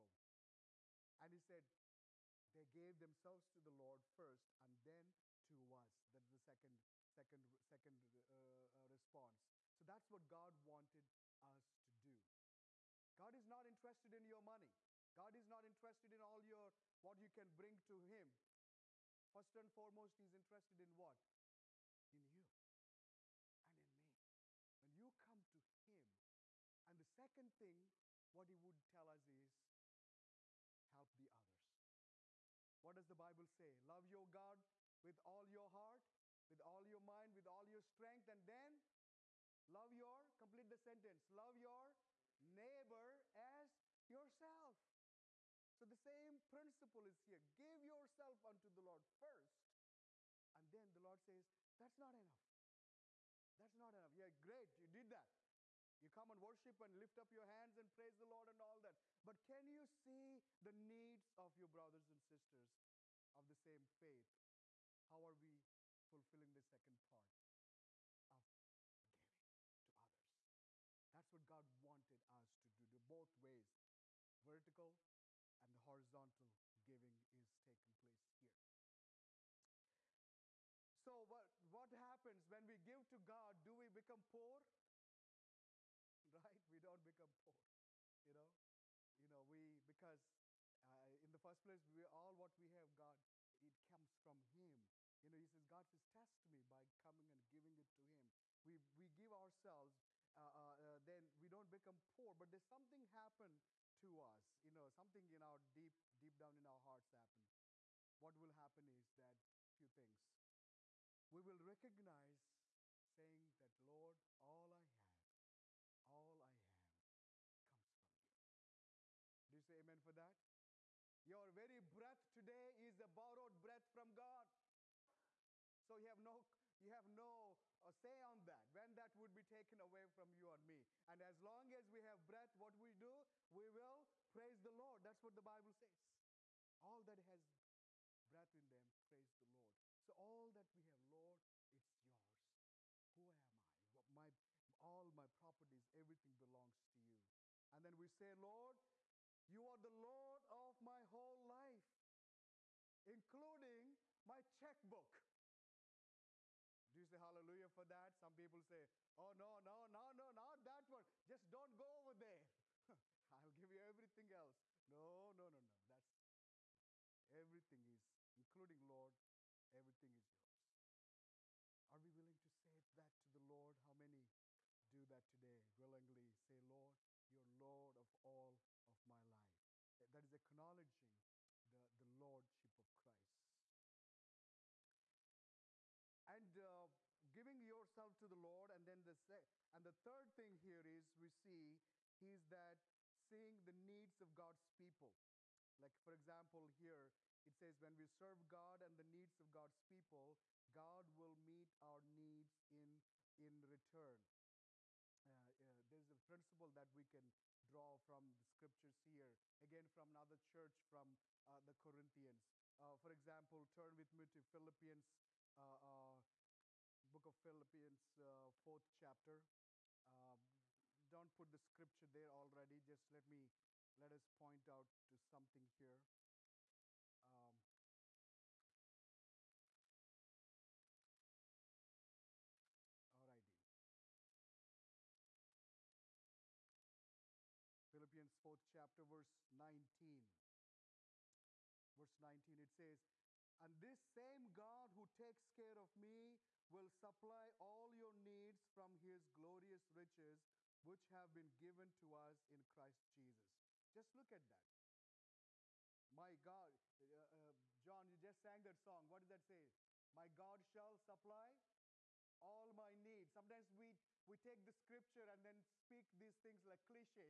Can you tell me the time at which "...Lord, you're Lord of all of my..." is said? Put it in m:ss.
2:56.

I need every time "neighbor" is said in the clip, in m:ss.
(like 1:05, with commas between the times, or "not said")
0:42.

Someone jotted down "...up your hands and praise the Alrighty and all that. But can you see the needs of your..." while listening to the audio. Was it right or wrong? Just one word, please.
wrong.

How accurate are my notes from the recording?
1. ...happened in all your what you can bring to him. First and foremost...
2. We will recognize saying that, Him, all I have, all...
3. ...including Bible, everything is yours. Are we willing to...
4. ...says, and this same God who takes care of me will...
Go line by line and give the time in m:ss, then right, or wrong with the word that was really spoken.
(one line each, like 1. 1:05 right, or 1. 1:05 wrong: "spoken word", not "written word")
1. 0:15 wrong: "interested", not "happened"
2. 1:51 wrong: "Lord", not "Him"
3. 2:48 wrong: "Lord", not "Bible"
4. 4:02 right.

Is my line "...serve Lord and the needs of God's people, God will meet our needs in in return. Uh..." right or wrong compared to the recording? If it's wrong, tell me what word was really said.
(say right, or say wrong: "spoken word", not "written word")
wrong: "God", not "Lord".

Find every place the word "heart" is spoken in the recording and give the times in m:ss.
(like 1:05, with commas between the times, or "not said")
0:35, 1:46.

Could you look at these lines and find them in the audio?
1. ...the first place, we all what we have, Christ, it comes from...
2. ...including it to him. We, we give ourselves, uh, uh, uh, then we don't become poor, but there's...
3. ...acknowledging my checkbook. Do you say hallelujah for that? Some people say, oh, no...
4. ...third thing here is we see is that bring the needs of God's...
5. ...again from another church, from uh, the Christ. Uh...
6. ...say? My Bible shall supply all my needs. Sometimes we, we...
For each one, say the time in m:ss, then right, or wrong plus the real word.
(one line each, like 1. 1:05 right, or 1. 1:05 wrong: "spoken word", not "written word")
1. 1:31 wrong: "God", not "Christ"
2. 1:37 wrong: "giving", not "including"
3. 2:33 wrong: "including", not "acknowledging"
4. 3:10 wrong: "seeing", not "bring"
5. 3:29 wrong: "Corinthians", not "Christ"
6. 4:19 wrong: "God", not "Bible".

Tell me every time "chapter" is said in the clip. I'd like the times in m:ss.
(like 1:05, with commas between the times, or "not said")
3:38, 3:58.